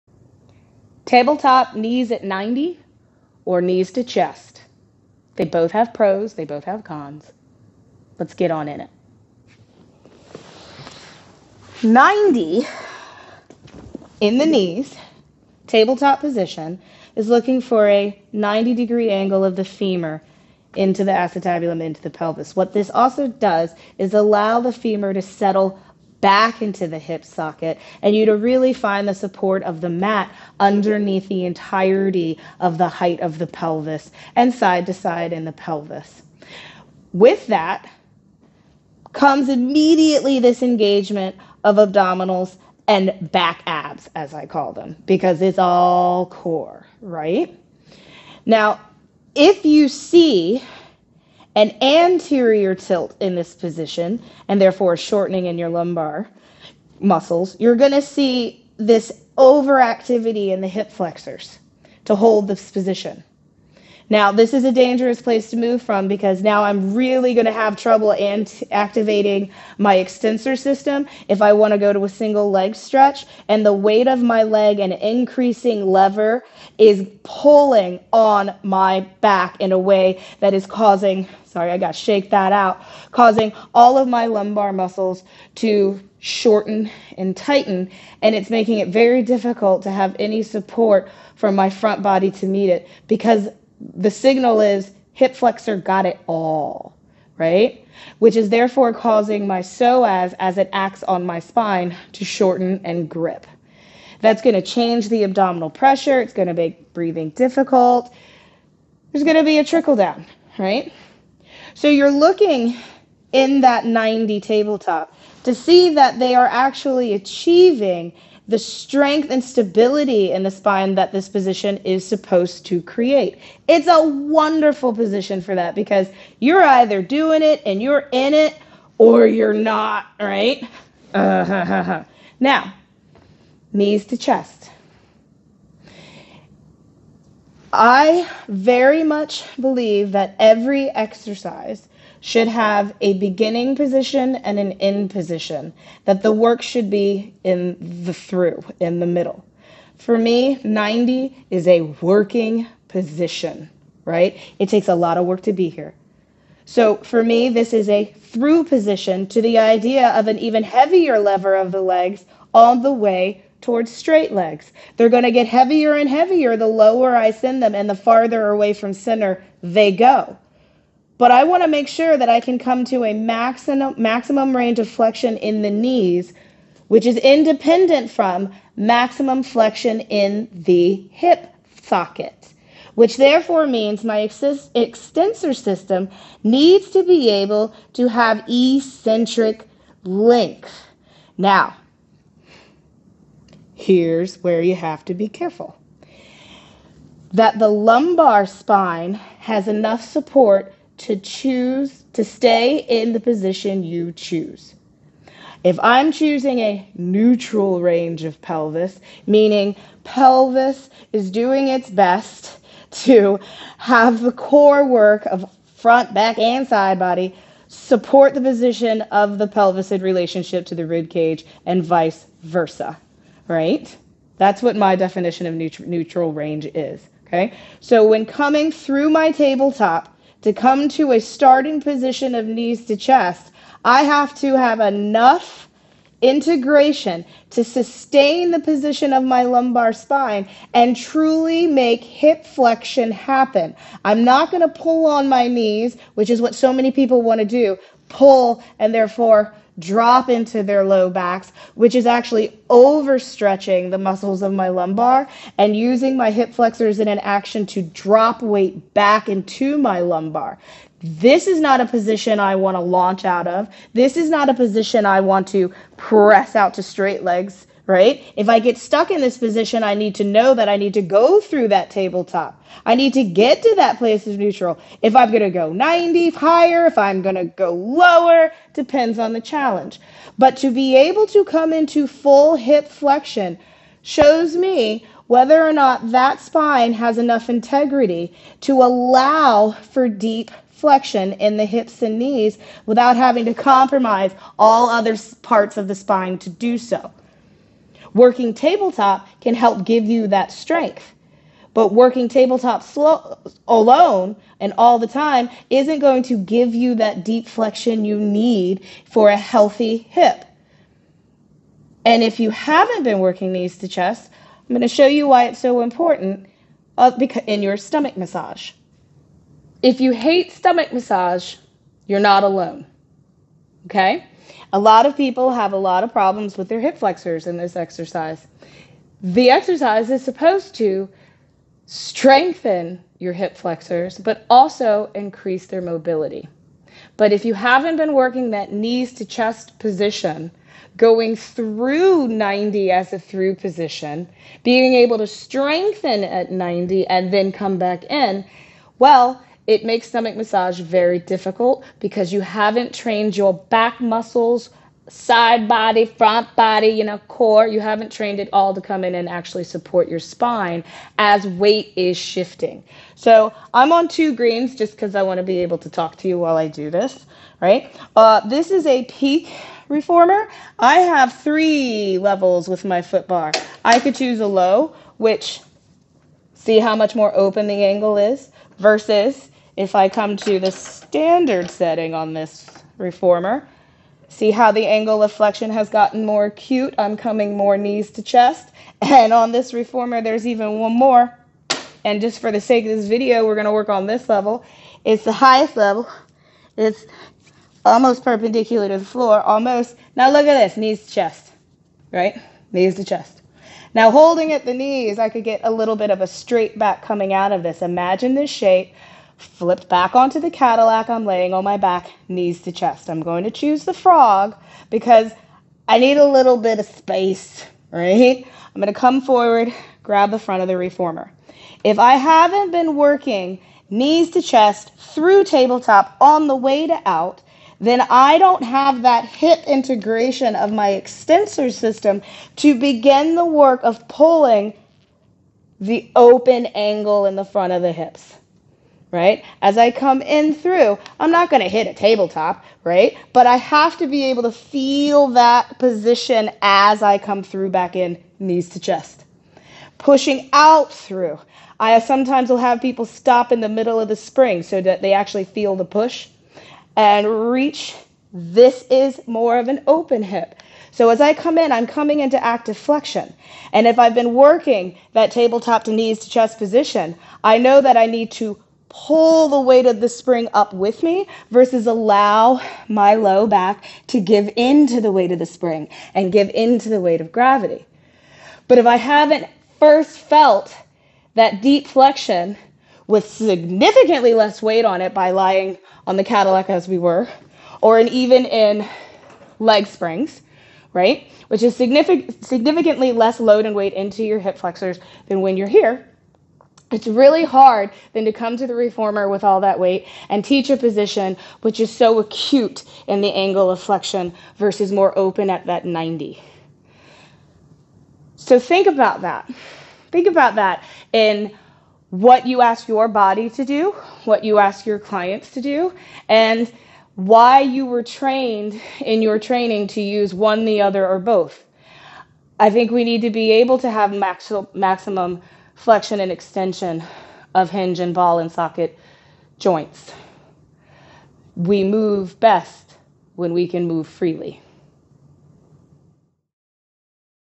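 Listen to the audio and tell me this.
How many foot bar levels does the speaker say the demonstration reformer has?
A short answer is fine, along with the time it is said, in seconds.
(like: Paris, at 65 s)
3, at 371 s.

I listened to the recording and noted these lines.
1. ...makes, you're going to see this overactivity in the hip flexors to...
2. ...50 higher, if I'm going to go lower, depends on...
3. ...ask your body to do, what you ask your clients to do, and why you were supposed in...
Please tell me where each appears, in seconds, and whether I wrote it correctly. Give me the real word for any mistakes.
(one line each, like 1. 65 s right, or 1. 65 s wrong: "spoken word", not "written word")
1. 56 s wrong: "muscles", not "makes"
2. 275 s wrong: "90", not "50"
3. 512 s wrong: "trained", not "supposed".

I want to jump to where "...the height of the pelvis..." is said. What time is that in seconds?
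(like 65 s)
32 s.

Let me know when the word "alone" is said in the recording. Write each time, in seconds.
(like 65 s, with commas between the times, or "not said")
303 s, 322 s.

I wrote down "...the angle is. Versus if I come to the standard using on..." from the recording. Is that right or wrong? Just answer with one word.
wrong.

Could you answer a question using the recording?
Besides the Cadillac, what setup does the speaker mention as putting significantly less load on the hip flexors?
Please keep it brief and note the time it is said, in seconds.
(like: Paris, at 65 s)
leg springs, at 489 s.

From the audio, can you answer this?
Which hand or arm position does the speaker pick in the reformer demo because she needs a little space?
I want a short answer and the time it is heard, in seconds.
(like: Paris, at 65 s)
frog, at 413 s.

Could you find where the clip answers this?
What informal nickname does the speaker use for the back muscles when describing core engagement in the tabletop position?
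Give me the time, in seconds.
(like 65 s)
43 s.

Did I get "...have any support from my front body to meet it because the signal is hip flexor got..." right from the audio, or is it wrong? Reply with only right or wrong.
right.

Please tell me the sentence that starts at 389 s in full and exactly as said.
And on this reformer, there's even one more.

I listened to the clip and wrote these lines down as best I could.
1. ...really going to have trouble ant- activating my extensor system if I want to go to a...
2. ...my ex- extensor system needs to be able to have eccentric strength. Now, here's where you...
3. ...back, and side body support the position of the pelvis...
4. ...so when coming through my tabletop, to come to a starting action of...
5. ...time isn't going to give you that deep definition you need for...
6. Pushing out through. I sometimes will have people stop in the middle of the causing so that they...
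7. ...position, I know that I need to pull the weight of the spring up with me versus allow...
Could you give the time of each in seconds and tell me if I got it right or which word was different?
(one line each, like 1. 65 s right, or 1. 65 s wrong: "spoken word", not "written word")
1. 66 s right
2. 184 s wrong: "length", not "strength"
3. 216 s right
4. 227 s wrong: "position", not "action"
5. 305 s wrong: "flexion", not "definition"
6. 449 s wrong: "spring", not "causing"
7. 466 s right.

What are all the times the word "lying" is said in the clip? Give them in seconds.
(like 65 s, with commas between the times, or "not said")
485 s.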